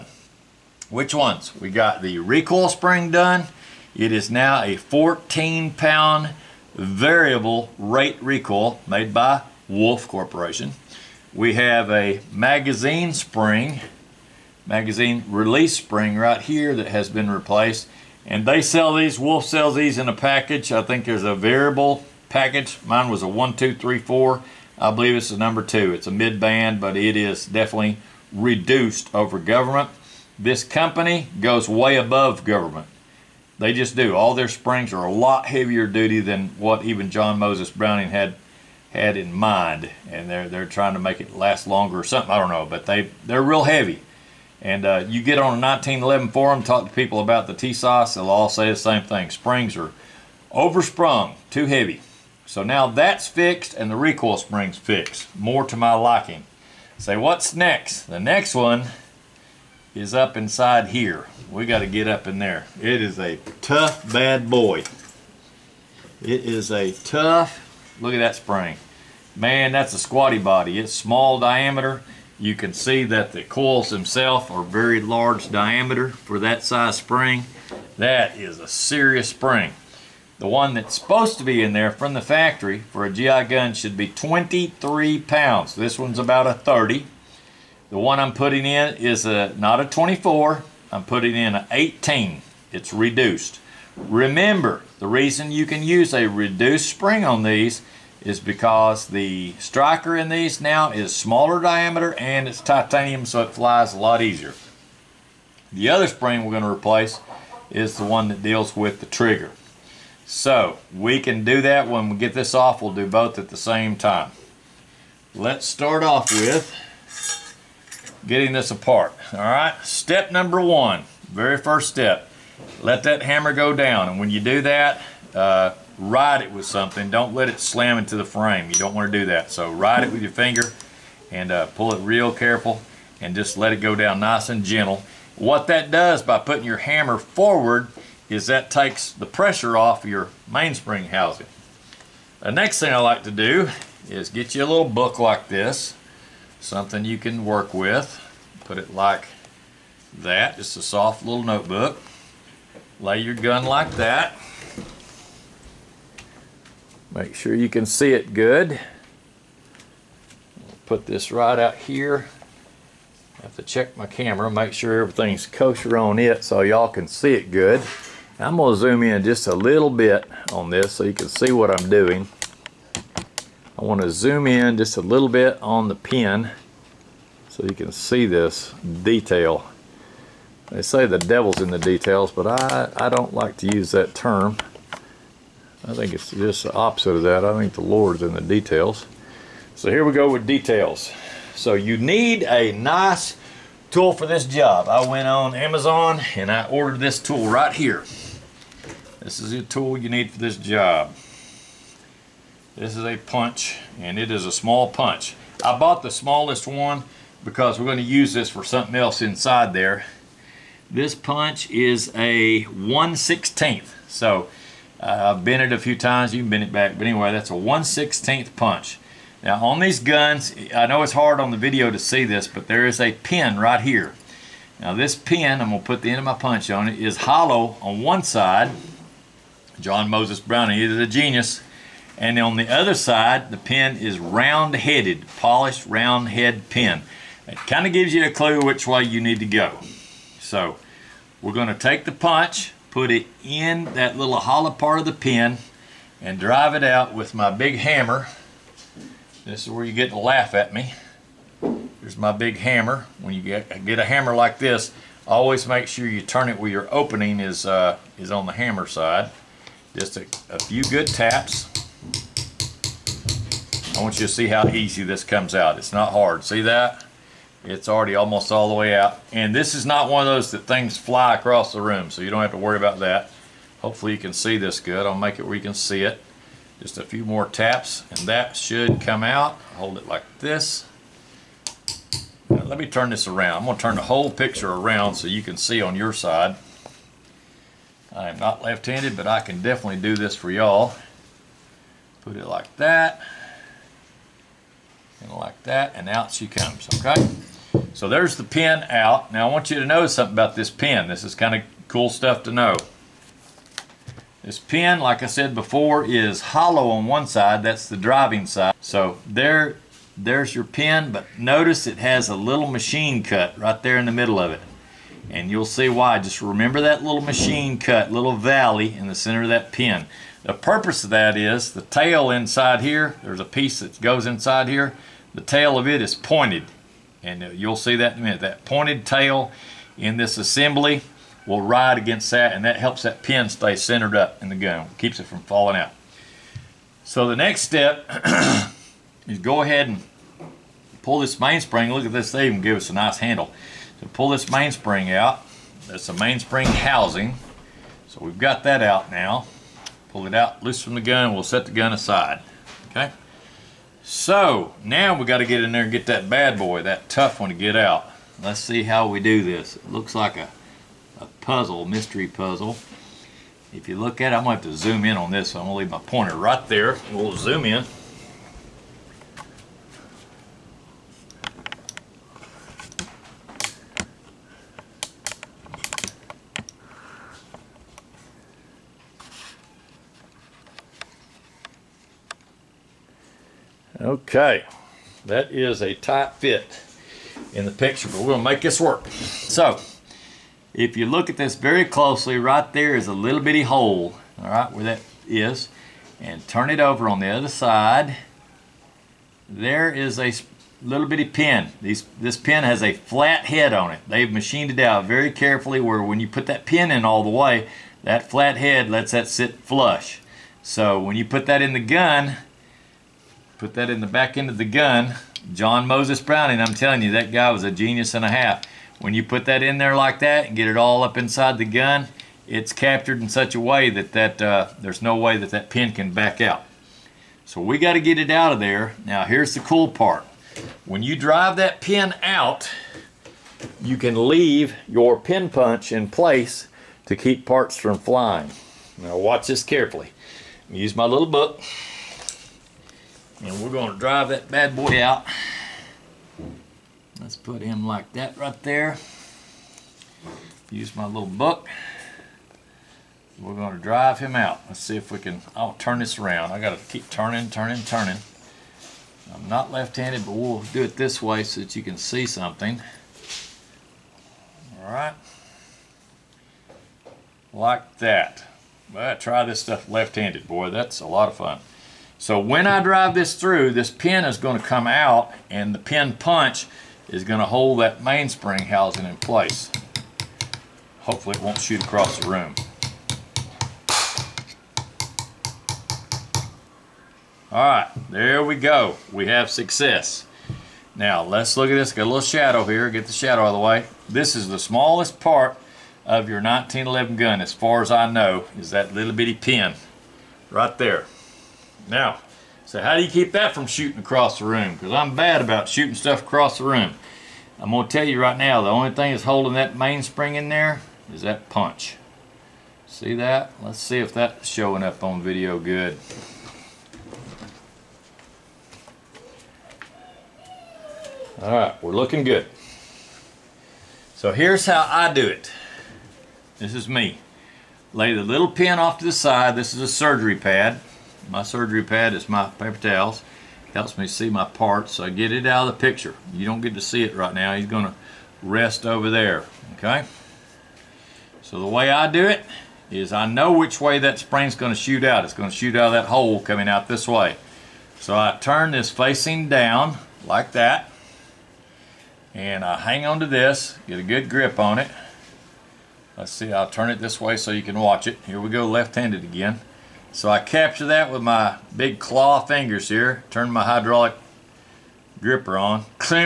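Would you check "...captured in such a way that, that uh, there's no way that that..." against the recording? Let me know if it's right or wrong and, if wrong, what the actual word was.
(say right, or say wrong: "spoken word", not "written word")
right.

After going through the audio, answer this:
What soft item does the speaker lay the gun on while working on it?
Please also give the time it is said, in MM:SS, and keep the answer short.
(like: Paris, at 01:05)
notebook, at 02:31.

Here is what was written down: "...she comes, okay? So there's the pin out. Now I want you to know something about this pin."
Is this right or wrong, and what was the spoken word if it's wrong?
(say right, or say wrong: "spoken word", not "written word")
right.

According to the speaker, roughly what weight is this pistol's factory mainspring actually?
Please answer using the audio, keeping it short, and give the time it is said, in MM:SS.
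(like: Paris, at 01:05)
30, at 01:26.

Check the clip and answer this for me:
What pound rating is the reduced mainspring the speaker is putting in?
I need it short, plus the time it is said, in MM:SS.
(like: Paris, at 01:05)
18, at 01:31.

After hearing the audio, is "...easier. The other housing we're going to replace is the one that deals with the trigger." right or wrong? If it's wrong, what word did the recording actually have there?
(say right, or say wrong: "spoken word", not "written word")
wrong: "spring", not "housing".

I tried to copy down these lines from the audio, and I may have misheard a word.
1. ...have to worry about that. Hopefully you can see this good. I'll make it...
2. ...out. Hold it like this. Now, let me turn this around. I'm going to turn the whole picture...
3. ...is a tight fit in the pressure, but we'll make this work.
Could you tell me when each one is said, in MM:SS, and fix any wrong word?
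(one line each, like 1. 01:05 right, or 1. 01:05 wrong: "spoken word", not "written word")
1. 04:32 right
2. 04:39 right
3. 06:25 wrong: "picture", not "pressure".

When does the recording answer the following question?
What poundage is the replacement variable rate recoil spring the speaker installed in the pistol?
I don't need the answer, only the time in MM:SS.
00:04.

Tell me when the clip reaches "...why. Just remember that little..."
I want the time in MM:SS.
05:15.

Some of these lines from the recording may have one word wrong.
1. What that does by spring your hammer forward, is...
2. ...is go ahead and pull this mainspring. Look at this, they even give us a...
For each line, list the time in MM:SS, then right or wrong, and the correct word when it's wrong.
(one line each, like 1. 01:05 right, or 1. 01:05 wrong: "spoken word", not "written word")
1. 02:15 wrong: "putting", not "spring"
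2. 05:39 right.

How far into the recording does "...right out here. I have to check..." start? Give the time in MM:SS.
02:41.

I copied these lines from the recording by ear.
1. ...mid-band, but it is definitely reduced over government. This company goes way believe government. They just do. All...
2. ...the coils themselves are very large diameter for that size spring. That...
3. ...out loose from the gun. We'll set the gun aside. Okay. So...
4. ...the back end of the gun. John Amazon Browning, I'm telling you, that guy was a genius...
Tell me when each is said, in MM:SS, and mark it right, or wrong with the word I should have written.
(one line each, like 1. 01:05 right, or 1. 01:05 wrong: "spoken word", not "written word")
1. 00:26 wrong: "above", not "believe"
2. 01:13 right
3. 05:50 right
4. 06:53 wrong: "Moses", not "Amazon".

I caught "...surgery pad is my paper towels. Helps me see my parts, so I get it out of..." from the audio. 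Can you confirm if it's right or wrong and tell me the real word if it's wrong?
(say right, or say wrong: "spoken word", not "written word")
right.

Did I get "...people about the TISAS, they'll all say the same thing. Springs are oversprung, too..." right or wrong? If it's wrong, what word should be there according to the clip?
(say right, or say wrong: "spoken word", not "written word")
right.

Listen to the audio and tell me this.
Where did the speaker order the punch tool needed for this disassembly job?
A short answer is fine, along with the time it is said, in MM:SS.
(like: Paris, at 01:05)
Amazon, at 03:15.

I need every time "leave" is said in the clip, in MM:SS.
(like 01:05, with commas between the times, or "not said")
06:05, 07:14.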